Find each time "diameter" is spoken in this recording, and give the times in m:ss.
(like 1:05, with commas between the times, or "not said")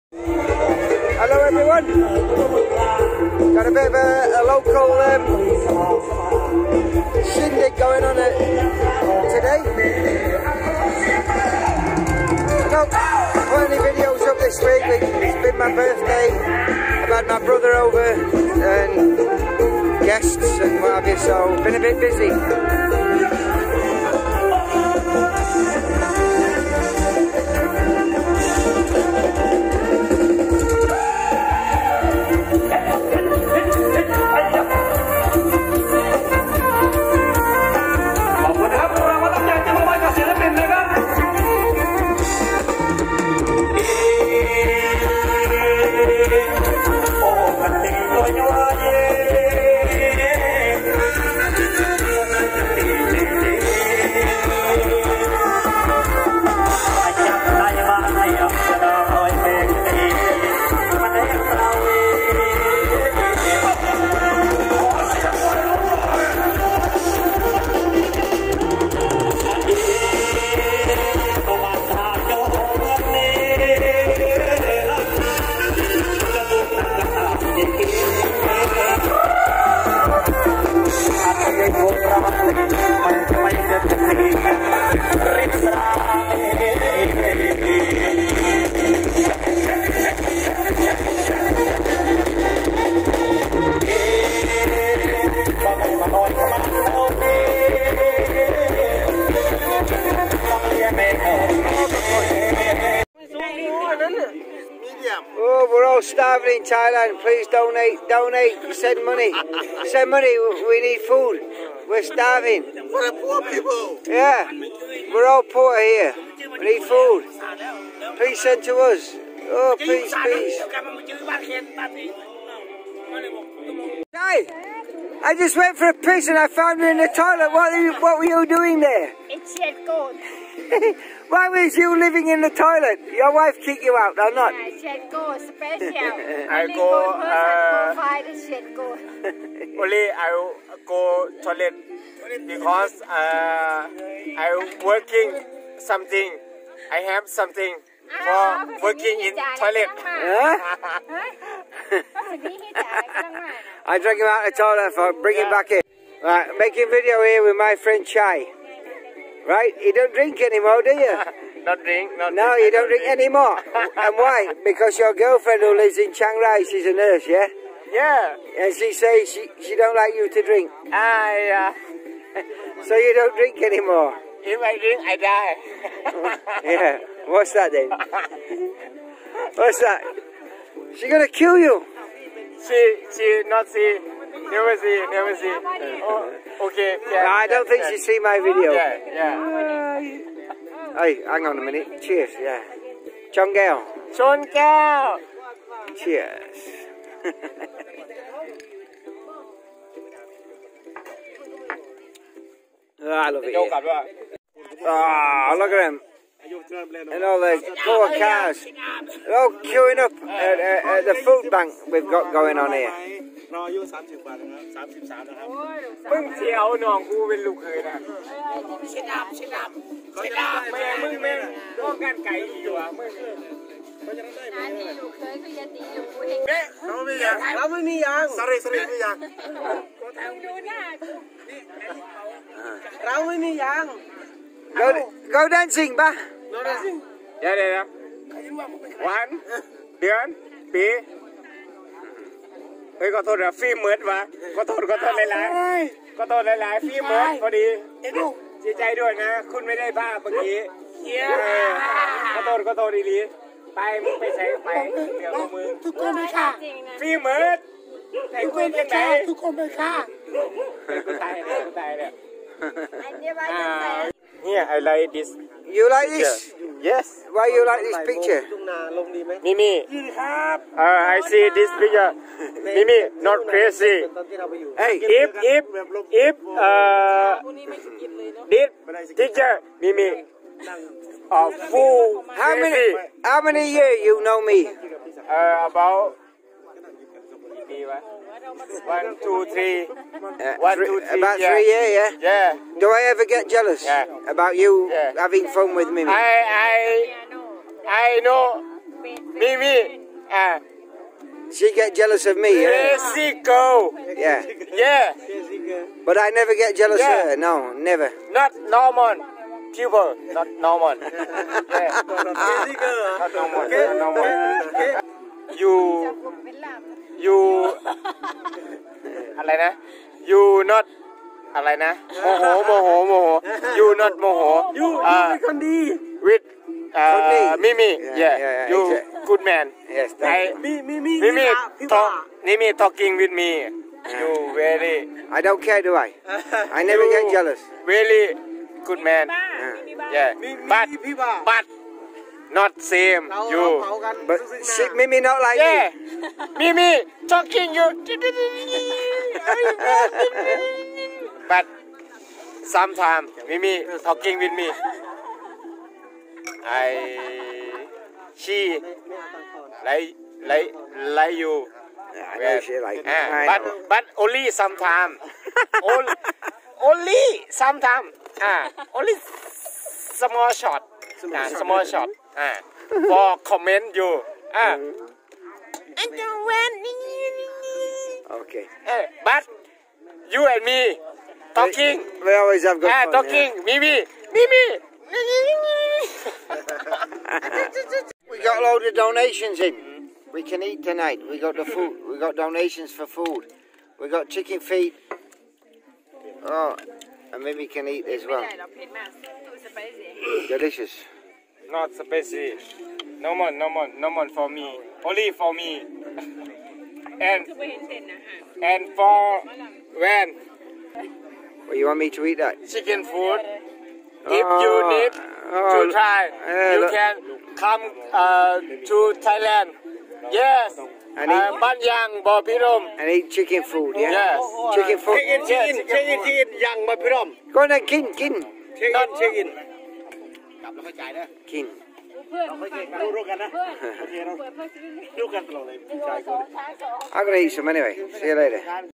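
not said.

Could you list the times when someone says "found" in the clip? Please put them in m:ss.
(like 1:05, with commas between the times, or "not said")
2:06.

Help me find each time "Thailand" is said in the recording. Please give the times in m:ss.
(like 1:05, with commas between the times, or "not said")
1:46, 6:59.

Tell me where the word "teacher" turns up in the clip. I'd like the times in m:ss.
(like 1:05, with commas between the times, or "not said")
4:39.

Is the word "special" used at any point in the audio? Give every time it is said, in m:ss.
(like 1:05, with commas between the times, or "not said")
2:15.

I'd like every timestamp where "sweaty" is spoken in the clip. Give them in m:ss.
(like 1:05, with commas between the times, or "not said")
not said.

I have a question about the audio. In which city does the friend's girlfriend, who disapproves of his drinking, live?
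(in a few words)
Chiang Rai.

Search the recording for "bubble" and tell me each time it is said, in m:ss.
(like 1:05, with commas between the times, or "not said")
not said.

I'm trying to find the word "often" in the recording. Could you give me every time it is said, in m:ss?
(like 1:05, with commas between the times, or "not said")
not said.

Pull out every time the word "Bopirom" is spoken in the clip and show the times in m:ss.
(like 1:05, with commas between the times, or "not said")
7:02, 7:06.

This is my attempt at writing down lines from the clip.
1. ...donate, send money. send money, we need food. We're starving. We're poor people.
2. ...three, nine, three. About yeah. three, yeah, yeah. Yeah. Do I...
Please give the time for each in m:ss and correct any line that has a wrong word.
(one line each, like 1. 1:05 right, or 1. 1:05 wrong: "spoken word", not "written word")
1. 1:48 right
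2. 4:50 wrong: "two", not "nine".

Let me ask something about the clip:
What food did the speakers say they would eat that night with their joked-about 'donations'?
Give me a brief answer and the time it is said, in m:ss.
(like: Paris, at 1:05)
Chicken feet, at 6:34.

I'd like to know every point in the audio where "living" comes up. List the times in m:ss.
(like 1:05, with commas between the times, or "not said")
2:11.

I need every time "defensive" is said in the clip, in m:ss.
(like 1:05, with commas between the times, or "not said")
not said.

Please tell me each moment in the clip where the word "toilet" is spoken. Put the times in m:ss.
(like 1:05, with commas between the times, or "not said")
2:07, 2:12, 2:21, 2:29, 2:34.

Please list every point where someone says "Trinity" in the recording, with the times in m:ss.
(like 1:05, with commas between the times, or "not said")
not said.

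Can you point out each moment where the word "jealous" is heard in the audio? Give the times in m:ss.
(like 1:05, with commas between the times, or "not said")
4:53, 5:01, 5:06, 5:37.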